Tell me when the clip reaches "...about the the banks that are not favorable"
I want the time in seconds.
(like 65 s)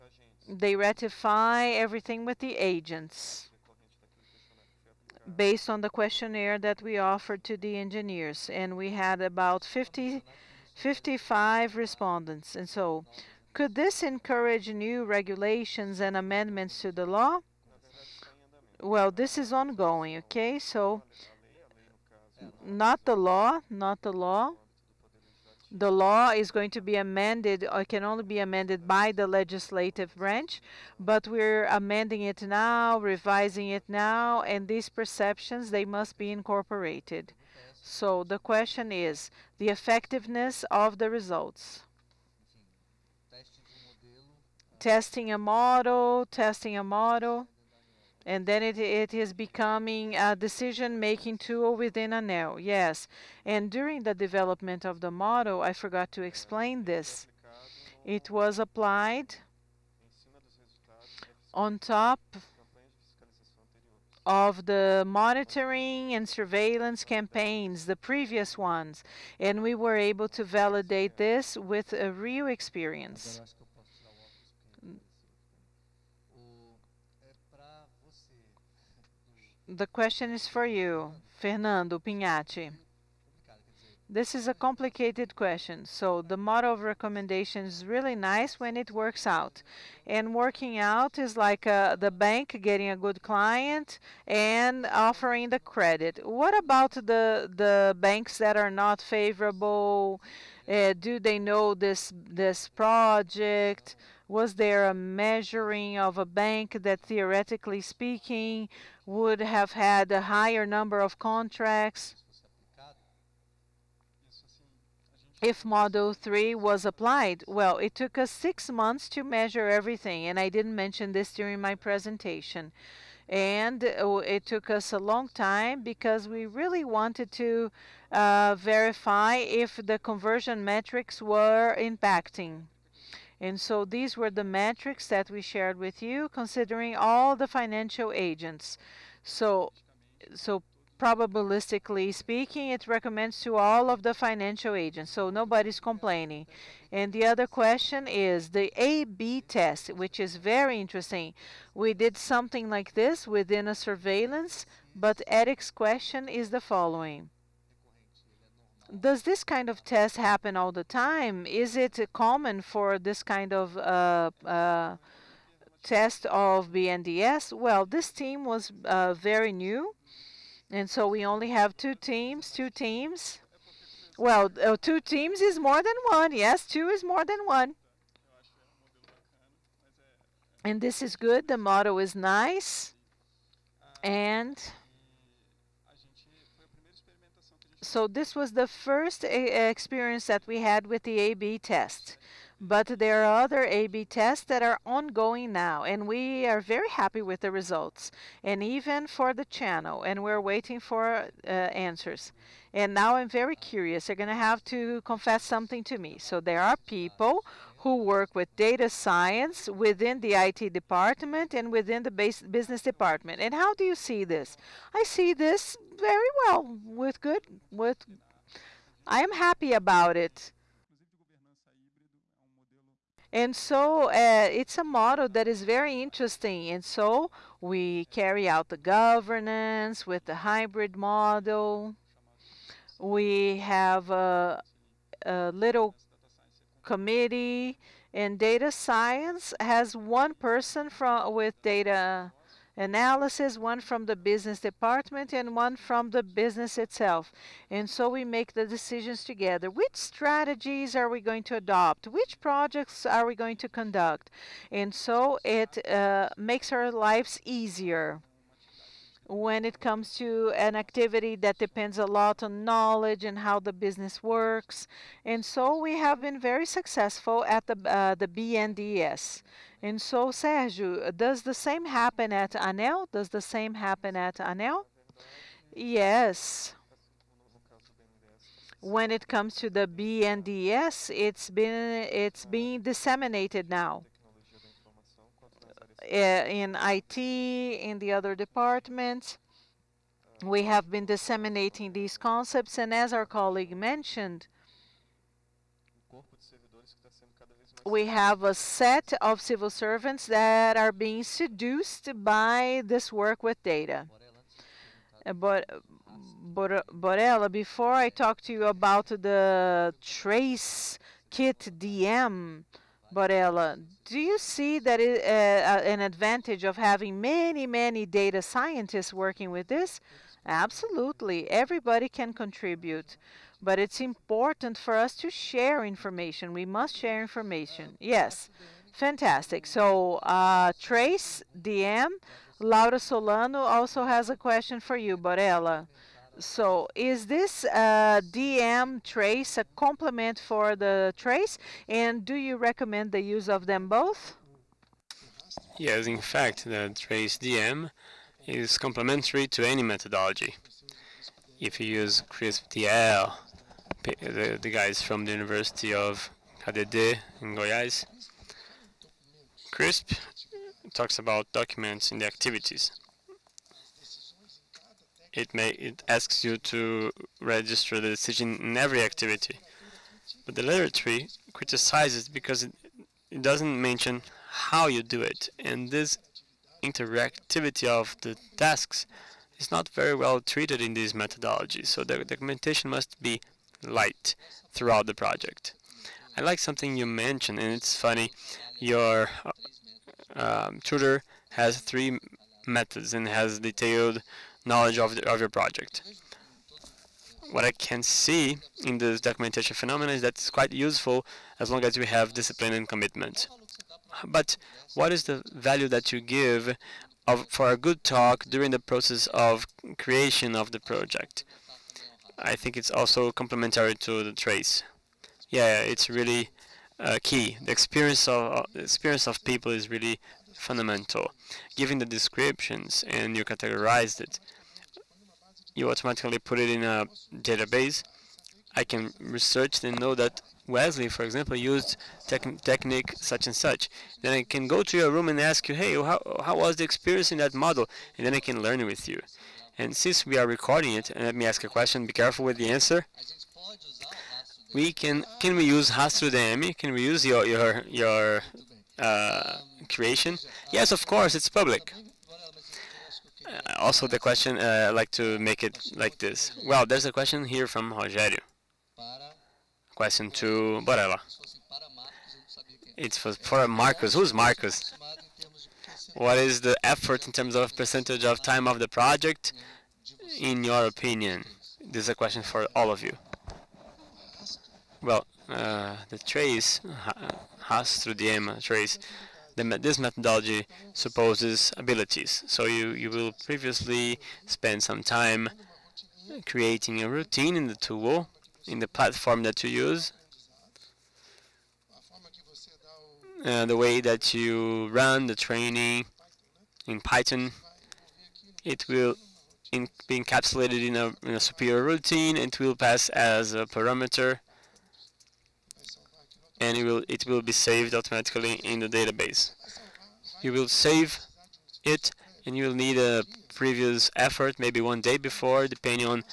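96 s.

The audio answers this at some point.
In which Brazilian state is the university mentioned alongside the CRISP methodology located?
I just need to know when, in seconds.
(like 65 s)
357 s.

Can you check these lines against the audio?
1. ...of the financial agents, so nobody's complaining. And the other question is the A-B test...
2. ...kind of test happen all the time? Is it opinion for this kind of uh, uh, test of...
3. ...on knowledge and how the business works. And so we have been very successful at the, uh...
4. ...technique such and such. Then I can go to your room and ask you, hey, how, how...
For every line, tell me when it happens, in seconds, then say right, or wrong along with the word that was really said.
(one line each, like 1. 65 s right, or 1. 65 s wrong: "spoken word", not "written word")
1. 143 s right
2. 159 s wrong: "common", not "opinion"
3. 262 s right
4. 432 s right.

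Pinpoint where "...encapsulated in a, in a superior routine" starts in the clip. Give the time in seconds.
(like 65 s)
500 s.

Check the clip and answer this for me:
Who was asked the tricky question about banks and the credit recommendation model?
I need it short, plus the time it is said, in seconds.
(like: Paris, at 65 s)
Fernando Pinhatti, at 81 s.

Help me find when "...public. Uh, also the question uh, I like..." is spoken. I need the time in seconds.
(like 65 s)
451 s.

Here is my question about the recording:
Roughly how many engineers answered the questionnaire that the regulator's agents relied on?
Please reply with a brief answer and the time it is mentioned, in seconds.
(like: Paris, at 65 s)
55, at 10 s.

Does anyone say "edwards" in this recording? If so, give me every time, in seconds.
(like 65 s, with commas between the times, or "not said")
not said.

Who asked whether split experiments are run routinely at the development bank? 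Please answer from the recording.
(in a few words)
Eric.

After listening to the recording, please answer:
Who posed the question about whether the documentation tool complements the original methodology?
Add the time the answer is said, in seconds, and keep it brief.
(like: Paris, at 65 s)
Laura Solano, at 332 s.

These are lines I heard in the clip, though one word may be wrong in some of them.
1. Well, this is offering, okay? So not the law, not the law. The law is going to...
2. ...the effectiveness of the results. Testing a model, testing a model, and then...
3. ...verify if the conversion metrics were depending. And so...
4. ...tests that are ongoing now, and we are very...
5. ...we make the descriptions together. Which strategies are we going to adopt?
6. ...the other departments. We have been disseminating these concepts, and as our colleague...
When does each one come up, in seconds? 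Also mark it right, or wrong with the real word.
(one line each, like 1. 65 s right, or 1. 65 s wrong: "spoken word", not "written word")
1. 18 s wrong: "ongoing", not "offering"
2. 39 s right
3. 128 s wrong: "impacting", not "depending"
4. 194 s right
5. 248 s wrong: "decisions", not "descriptions"
6. 287 s right.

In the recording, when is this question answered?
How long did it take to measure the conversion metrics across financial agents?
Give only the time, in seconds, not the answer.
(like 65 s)
118 s.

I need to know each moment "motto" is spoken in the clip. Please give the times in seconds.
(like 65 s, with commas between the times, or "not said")
181 s.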